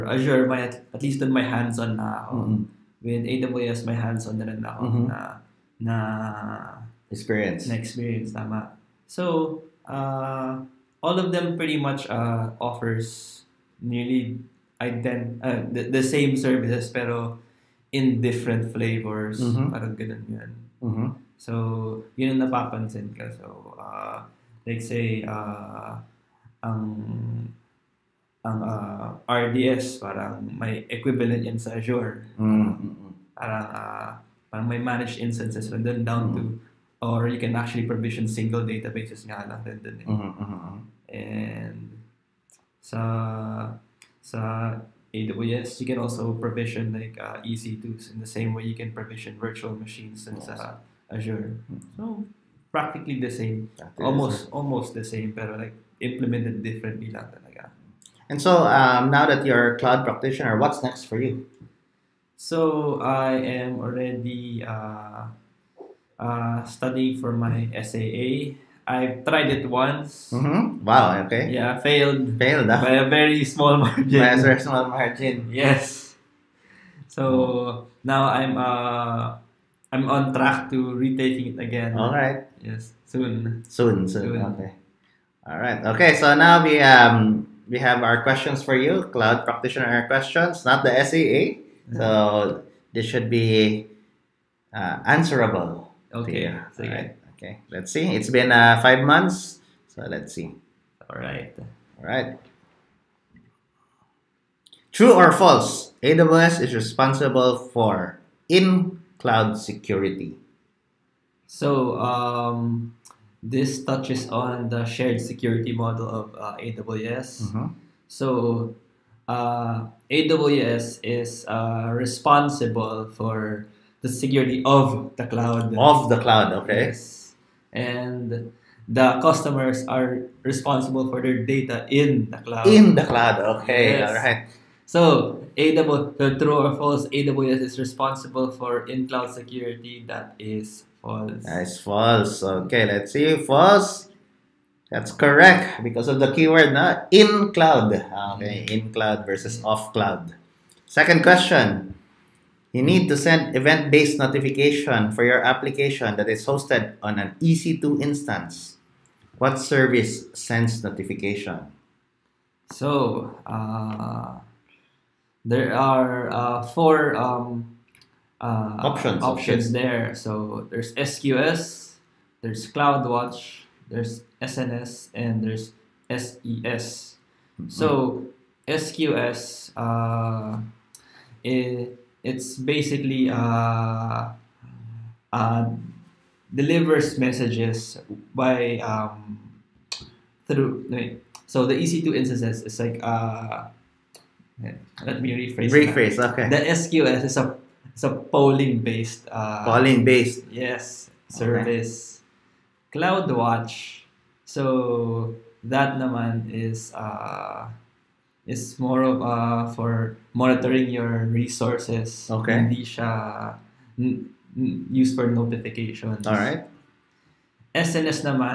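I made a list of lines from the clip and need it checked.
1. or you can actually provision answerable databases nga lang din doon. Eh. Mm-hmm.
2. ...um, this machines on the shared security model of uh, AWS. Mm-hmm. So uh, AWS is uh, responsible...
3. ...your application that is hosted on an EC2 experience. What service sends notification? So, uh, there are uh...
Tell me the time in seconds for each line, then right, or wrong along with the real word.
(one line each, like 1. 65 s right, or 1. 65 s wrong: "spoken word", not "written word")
1. 37 s wrong: "single", not "answerable"
2. 111 s wrong: "touches", not "machines"
3. 155 s wrong: "instance", not "experience".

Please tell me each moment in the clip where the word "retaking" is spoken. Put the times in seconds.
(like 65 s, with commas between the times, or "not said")
80 s.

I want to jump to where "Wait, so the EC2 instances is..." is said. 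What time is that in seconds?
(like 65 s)
190 s.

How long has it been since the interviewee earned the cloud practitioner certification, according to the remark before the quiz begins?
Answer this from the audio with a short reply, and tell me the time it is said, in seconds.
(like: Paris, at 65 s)
5 months, at 98 s.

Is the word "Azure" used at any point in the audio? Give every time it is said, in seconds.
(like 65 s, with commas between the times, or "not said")
0 s, 31 s, 51 s.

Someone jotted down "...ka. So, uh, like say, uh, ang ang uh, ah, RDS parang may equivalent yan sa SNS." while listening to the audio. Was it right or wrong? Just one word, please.
wrong.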